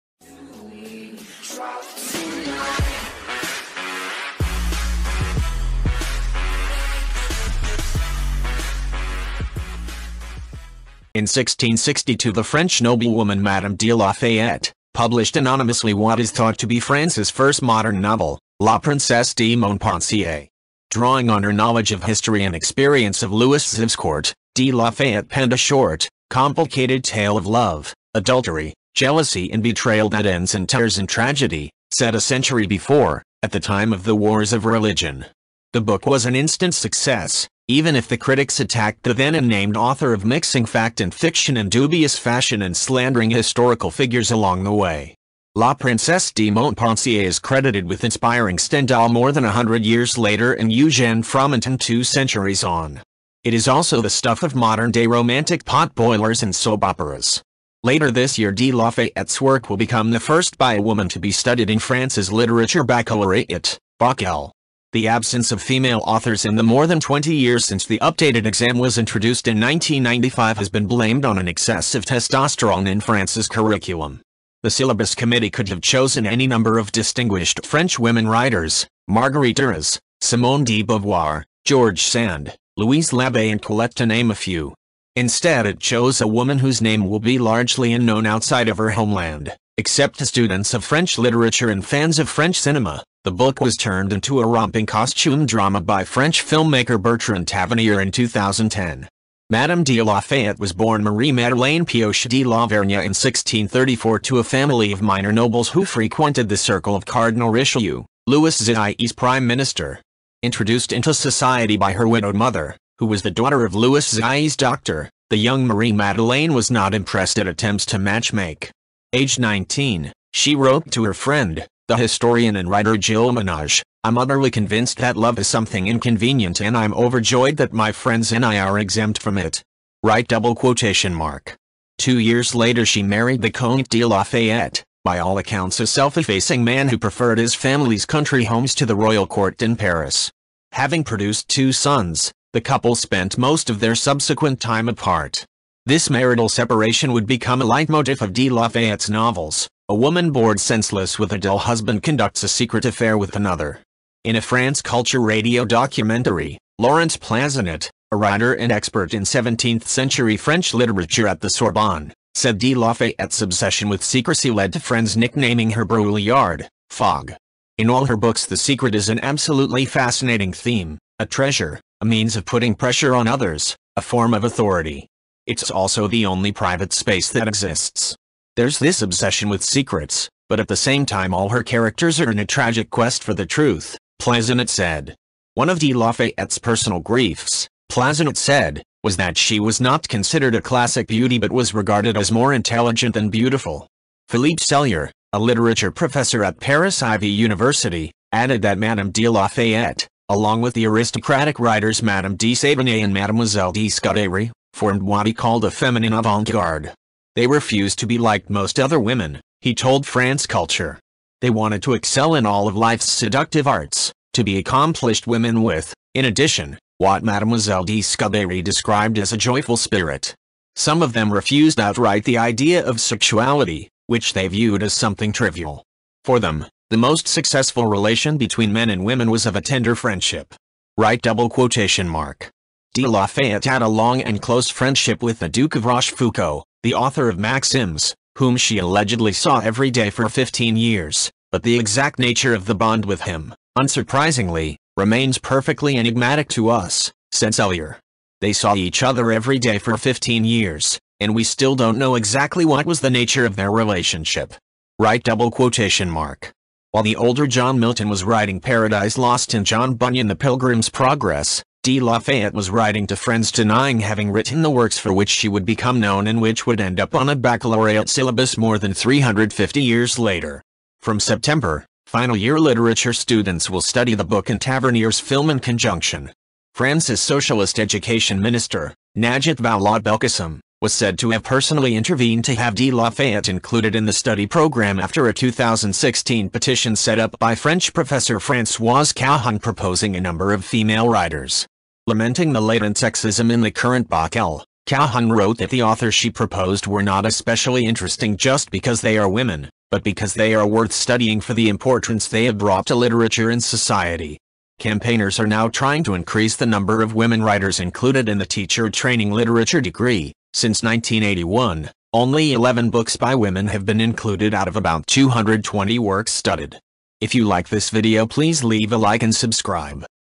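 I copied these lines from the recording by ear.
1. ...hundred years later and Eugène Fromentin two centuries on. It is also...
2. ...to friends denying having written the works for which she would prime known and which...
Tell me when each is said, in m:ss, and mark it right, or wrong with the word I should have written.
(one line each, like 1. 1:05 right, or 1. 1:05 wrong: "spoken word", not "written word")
1. 0:49 right
2. 4:23 wrong: "become", not "prime".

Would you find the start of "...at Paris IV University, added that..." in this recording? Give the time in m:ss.
3:16.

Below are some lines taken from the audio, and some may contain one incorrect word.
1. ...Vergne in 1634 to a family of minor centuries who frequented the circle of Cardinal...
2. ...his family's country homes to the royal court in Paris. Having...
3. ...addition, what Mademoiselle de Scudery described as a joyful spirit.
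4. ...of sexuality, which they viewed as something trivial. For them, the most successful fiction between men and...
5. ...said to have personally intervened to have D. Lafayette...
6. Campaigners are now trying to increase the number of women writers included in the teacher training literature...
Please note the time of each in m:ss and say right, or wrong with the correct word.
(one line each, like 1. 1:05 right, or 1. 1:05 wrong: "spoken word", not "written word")
1. 1:42 wrong: "nobles", not "centuries"
2. 2:17 right
3. 3:36 right
4. 3:42 wrong: "relation", not "fiction"
5. 4:40 right
6. 5:04 right.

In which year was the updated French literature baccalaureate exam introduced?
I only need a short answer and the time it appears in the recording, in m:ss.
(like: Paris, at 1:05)
1995, at 1:09.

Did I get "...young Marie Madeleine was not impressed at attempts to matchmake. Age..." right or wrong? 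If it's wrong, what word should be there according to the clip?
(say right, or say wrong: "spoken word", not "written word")
right.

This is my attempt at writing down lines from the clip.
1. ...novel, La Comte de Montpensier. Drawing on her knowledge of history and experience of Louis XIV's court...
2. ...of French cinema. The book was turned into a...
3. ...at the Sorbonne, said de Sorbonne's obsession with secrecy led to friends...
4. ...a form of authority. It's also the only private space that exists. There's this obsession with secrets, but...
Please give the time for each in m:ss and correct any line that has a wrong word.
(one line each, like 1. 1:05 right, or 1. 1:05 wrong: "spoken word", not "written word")
1. 0:18 wrong: "Princesse", not "Comte"
2. 1:32 right
3. 2:41 wrong: "Lafayette", not "Sorbonne"
4. 2:53 right.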